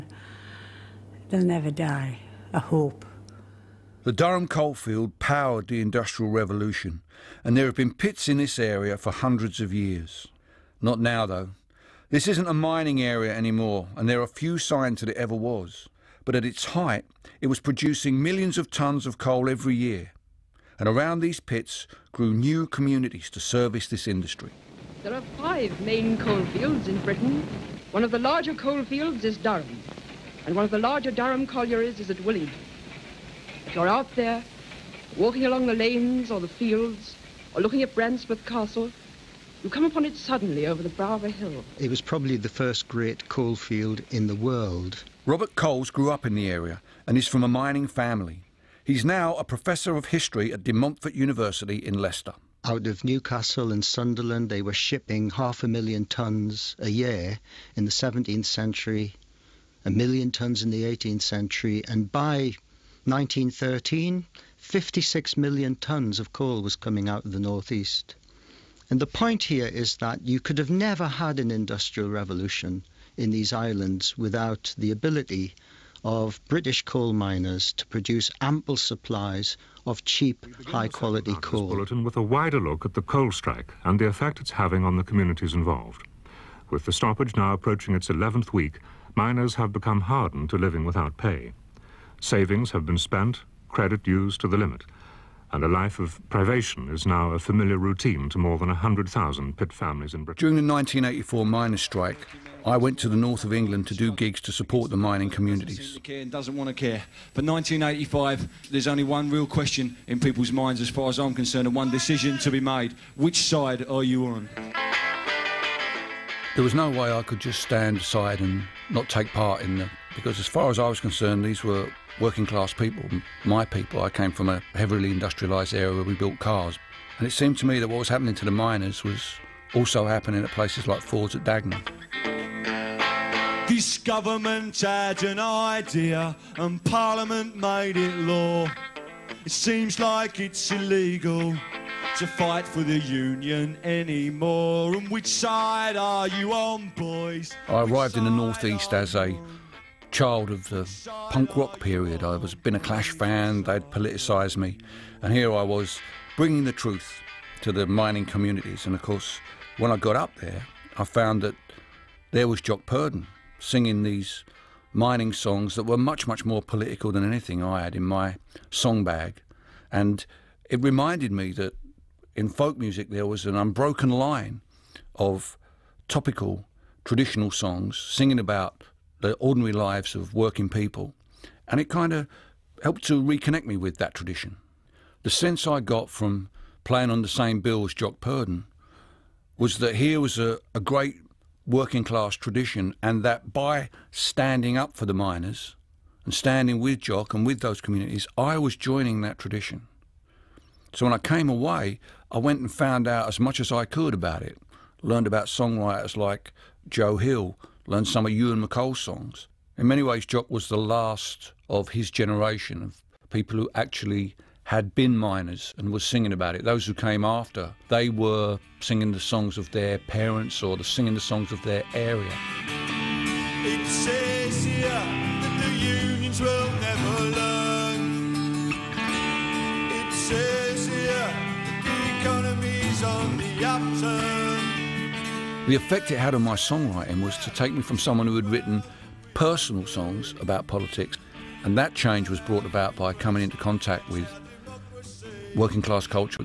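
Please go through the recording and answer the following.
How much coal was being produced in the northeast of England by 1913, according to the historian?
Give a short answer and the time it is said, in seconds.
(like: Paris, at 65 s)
56 million tonnes, at 64 s.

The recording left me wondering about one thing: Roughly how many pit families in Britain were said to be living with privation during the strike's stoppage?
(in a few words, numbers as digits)
more than 100,000.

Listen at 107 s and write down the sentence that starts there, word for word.
But 1985, there's only one real question in people's minds as far as I'm concerned and one decision to be made.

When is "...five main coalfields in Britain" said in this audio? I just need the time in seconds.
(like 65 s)
25 s.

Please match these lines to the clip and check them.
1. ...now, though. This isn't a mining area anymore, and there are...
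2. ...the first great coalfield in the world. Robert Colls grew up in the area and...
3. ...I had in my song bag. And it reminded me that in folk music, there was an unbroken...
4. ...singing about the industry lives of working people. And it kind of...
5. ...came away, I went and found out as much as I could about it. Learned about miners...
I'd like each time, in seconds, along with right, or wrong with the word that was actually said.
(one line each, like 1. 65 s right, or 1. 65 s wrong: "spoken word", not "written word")
1. 10 s right
2. 42 s right
3. 167 s right
4. 177 s wrong: "ordinary", not "industry"
5. 201 s wrong: "songwriters", not "miners".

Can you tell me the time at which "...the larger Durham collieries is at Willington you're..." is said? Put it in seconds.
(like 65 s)
30 s.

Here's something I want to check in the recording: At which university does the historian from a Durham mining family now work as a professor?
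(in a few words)
De Montfort University.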